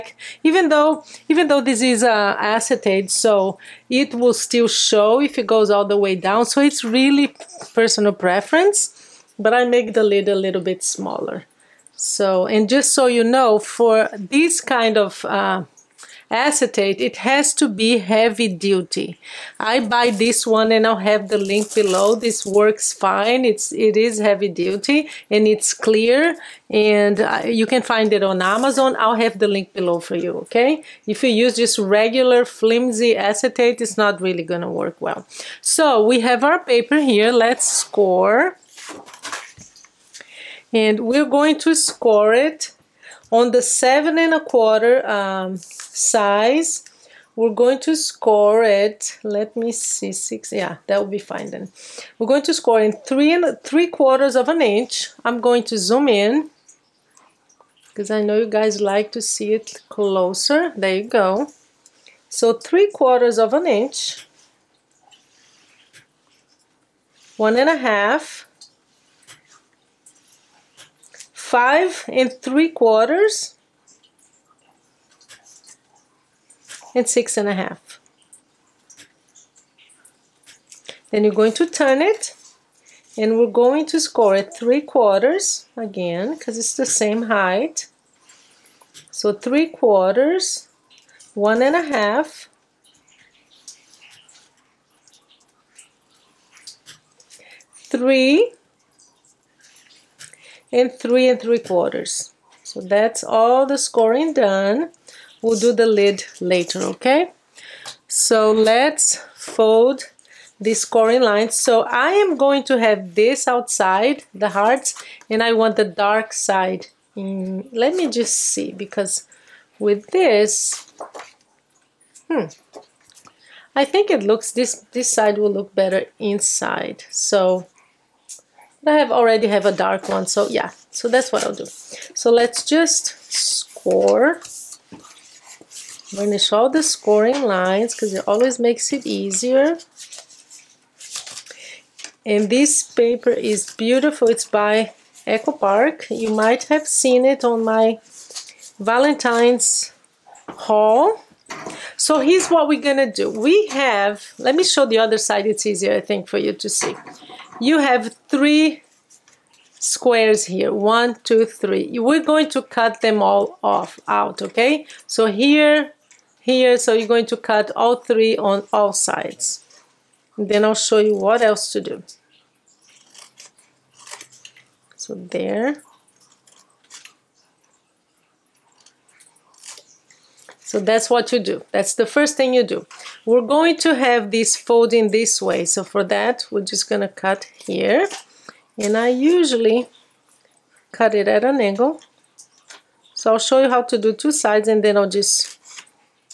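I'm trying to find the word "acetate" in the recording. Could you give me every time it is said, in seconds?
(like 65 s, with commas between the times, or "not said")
2 s, 16 s, 33 s.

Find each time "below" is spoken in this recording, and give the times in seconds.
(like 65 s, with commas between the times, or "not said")
21 s, 29 s.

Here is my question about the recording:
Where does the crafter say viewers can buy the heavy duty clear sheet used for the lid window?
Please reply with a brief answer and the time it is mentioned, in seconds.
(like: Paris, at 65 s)
Amazon, at 28 s.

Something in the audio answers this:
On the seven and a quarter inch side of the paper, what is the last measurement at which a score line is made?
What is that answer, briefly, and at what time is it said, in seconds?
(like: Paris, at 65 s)
6 1/2 inches, at 77 s.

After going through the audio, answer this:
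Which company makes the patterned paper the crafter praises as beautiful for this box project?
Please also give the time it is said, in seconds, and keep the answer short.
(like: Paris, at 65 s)
Echo Park, at 145 s.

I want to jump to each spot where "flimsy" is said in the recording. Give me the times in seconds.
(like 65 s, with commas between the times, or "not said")
32 s.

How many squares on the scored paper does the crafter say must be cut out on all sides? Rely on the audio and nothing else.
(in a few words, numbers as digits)
3.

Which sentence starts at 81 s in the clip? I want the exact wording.
Then you're going to turn it and we're going to score at three quarters again because it's the same height.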